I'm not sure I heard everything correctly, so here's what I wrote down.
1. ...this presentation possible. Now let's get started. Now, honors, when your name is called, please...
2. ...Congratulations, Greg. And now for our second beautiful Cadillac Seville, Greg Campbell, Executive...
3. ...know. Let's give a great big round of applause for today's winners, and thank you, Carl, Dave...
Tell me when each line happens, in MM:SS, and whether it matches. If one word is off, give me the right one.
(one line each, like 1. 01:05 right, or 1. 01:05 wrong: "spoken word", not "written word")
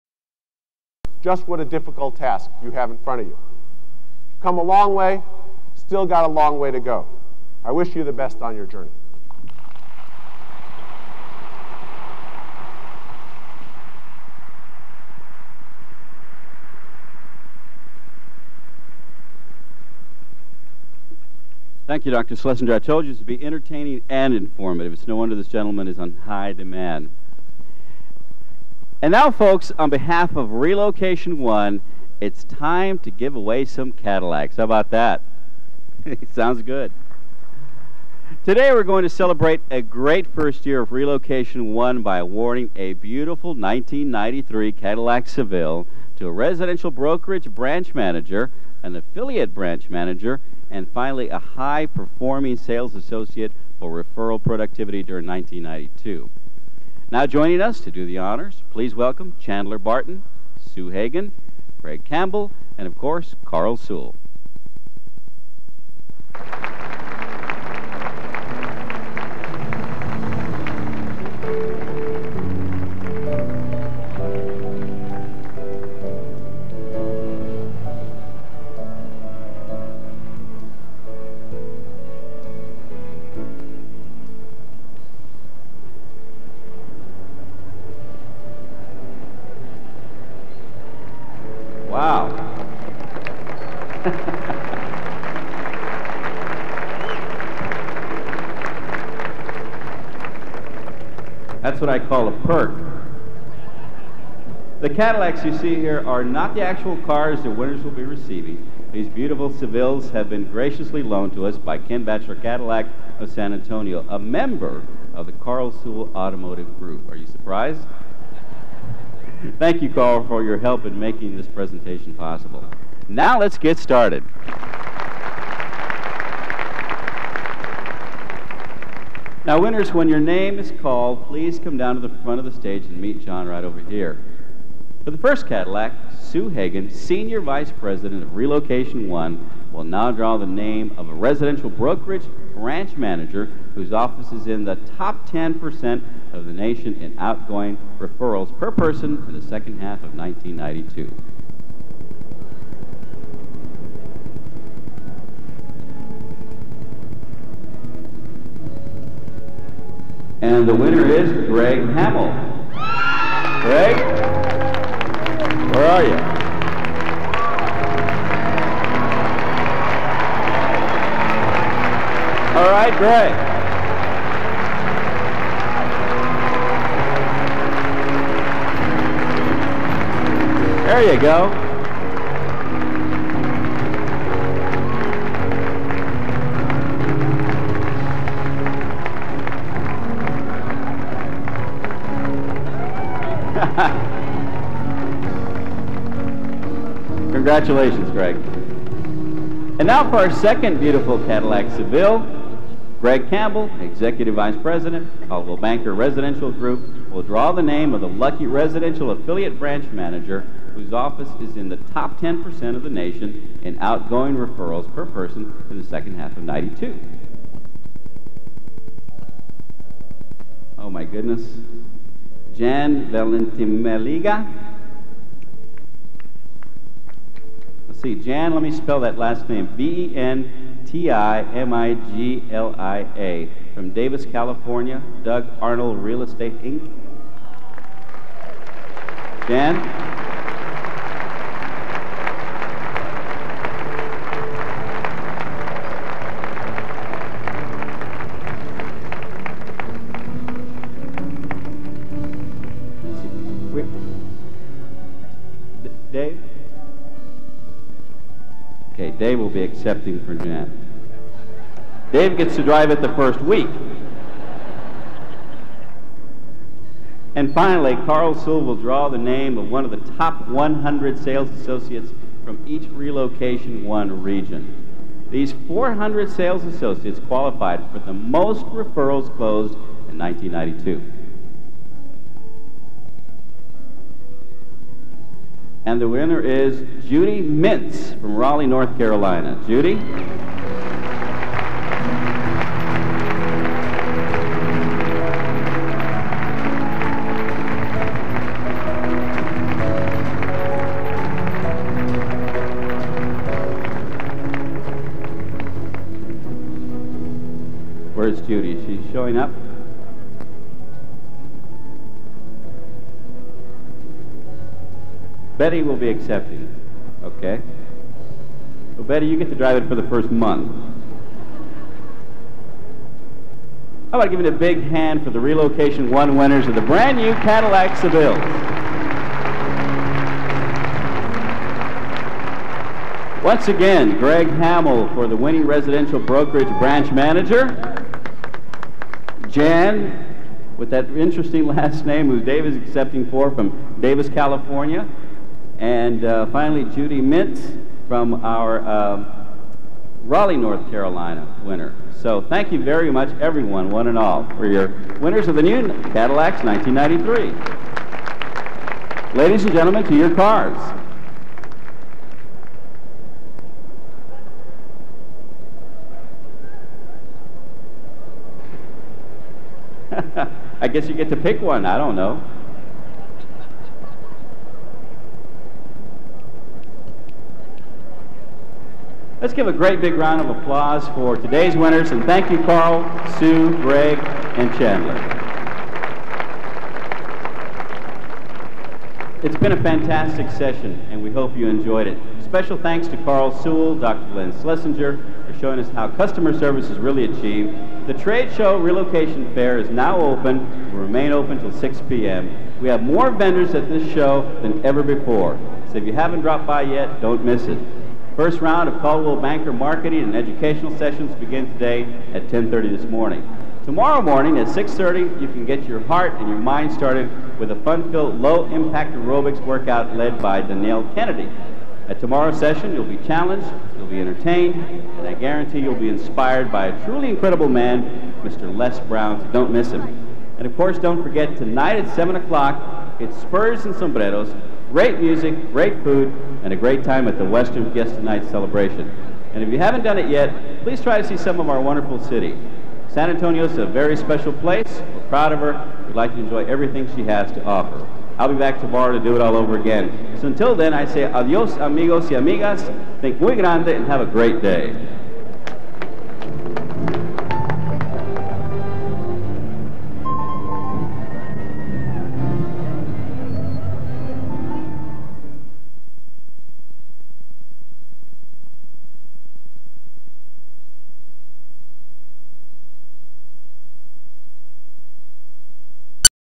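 1. 02:01 wrong: "winners", not "honors"
2. 03:17 right
3. 06:12 wrong: "Sue", not "Dave".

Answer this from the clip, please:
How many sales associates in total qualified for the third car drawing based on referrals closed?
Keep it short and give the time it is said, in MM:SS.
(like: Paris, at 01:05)
400, at 04:35.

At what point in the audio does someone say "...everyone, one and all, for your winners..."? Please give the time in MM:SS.
05:53.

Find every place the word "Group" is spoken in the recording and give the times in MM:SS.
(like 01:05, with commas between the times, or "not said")
01:56, 03:26.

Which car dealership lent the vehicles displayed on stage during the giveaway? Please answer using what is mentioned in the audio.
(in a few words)
Ken Batchelor Cadillac.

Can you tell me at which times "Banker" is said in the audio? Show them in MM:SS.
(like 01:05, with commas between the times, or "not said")
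03:25, 06:49.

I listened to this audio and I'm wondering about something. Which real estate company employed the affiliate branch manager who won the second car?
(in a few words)
Doug Arnold Real Estate.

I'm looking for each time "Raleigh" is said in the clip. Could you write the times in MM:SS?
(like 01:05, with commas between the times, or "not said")
04:48, 05:50.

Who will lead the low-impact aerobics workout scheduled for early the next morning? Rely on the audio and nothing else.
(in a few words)
Danielle Kennedy.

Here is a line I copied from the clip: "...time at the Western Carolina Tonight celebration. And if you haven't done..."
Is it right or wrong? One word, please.
wrong.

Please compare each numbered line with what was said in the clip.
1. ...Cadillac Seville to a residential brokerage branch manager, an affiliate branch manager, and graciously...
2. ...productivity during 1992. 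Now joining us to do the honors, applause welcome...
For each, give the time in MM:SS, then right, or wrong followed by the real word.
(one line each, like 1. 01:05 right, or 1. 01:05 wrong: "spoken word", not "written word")
1. 00:44 wrong: "finally", not "graciously"
2. 00:54 wrong: "please", not "applause".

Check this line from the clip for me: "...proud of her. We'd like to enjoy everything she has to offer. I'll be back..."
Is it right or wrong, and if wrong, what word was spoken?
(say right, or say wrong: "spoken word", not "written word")
right.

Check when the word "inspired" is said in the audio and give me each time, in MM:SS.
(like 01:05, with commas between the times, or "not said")
07:06.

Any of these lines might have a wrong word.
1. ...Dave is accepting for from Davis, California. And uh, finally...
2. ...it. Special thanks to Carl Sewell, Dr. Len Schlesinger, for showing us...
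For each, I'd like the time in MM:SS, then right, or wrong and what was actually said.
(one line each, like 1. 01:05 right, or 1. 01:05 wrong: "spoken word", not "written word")
1. 05:42 right
2. 06:32 right.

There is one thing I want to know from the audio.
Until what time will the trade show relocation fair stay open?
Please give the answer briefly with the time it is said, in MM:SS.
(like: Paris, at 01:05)
6 p.m., at 06:41.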